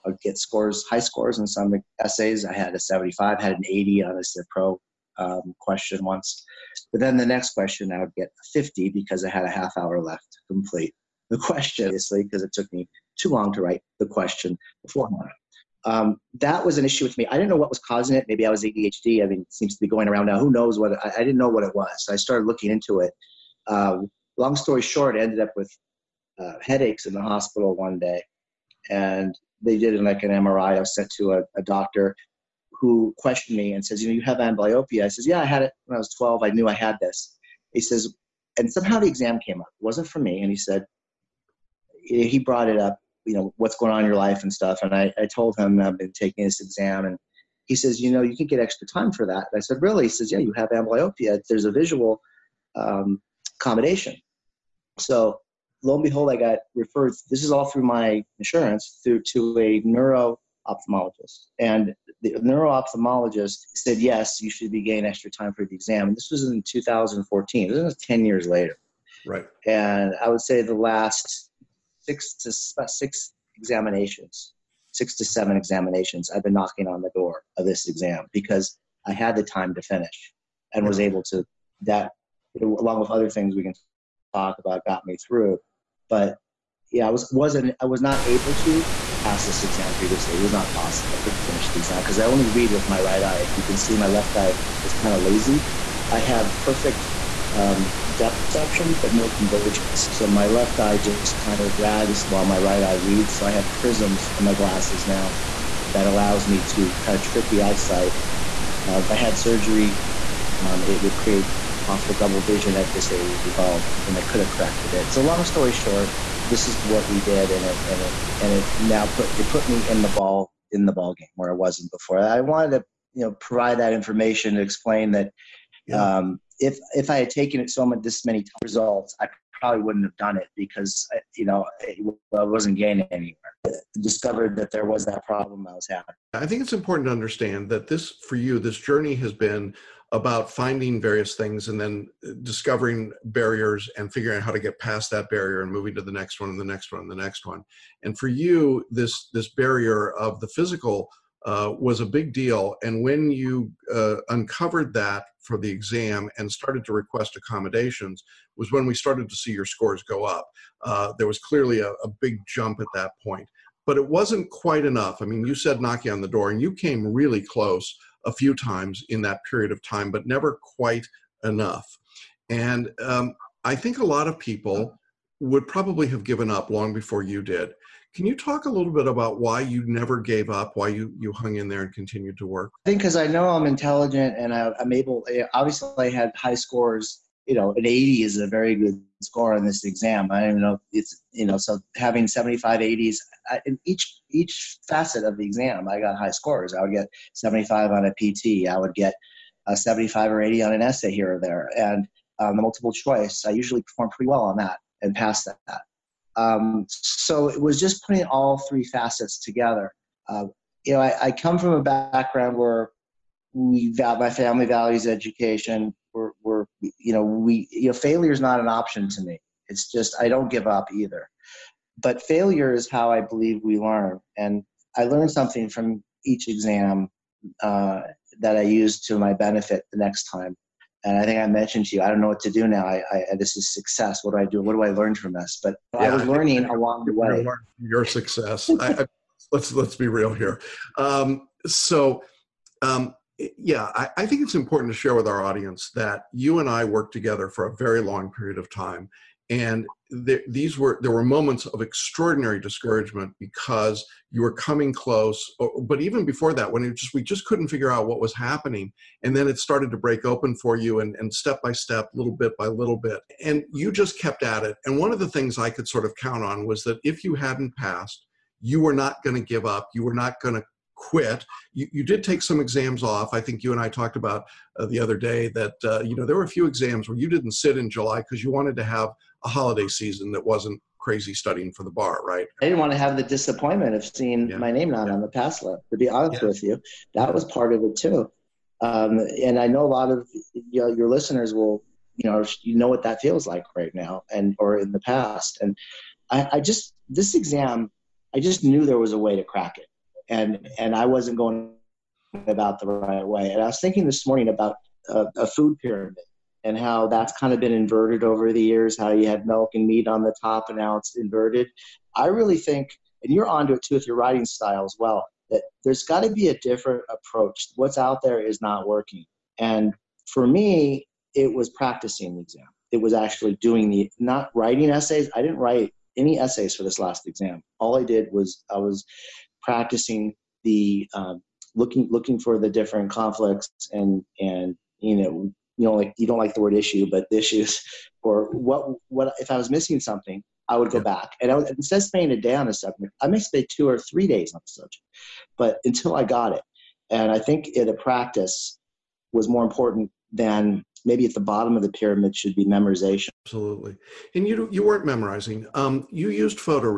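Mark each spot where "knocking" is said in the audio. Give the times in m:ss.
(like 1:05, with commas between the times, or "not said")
1:16, 2:45.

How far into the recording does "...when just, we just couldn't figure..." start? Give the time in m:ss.
4:16.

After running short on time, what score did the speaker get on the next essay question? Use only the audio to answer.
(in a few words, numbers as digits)
50.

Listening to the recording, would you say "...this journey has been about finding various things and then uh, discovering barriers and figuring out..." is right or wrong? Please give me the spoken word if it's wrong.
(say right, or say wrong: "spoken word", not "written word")
right.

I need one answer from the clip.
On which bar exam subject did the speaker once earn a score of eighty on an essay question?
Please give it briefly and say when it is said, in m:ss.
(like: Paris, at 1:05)
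Civ Pro, at 0:04.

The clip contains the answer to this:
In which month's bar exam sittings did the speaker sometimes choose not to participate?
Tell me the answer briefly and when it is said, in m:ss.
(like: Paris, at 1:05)
July, at 4:37.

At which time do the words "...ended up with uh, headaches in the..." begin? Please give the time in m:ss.
0:25.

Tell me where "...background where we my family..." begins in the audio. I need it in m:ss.
3:31.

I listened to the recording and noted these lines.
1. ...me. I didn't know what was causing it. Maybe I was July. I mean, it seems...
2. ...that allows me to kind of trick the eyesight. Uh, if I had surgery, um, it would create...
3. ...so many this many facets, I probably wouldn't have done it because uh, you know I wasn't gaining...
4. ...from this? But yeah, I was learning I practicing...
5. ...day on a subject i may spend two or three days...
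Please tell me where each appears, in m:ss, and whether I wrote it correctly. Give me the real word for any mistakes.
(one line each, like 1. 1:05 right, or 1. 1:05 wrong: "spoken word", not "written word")
1. 0:17 wrong: "ADHD", not "July"
2. 1:45 right
3. 2:07 wrong: "results", not "facets"
4. 3:55 wrong: "along", not "practicing"
5. 5:42 right.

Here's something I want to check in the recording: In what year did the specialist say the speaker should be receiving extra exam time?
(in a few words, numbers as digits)
2014.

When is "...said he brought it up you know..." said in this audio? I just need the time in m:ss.
0:40.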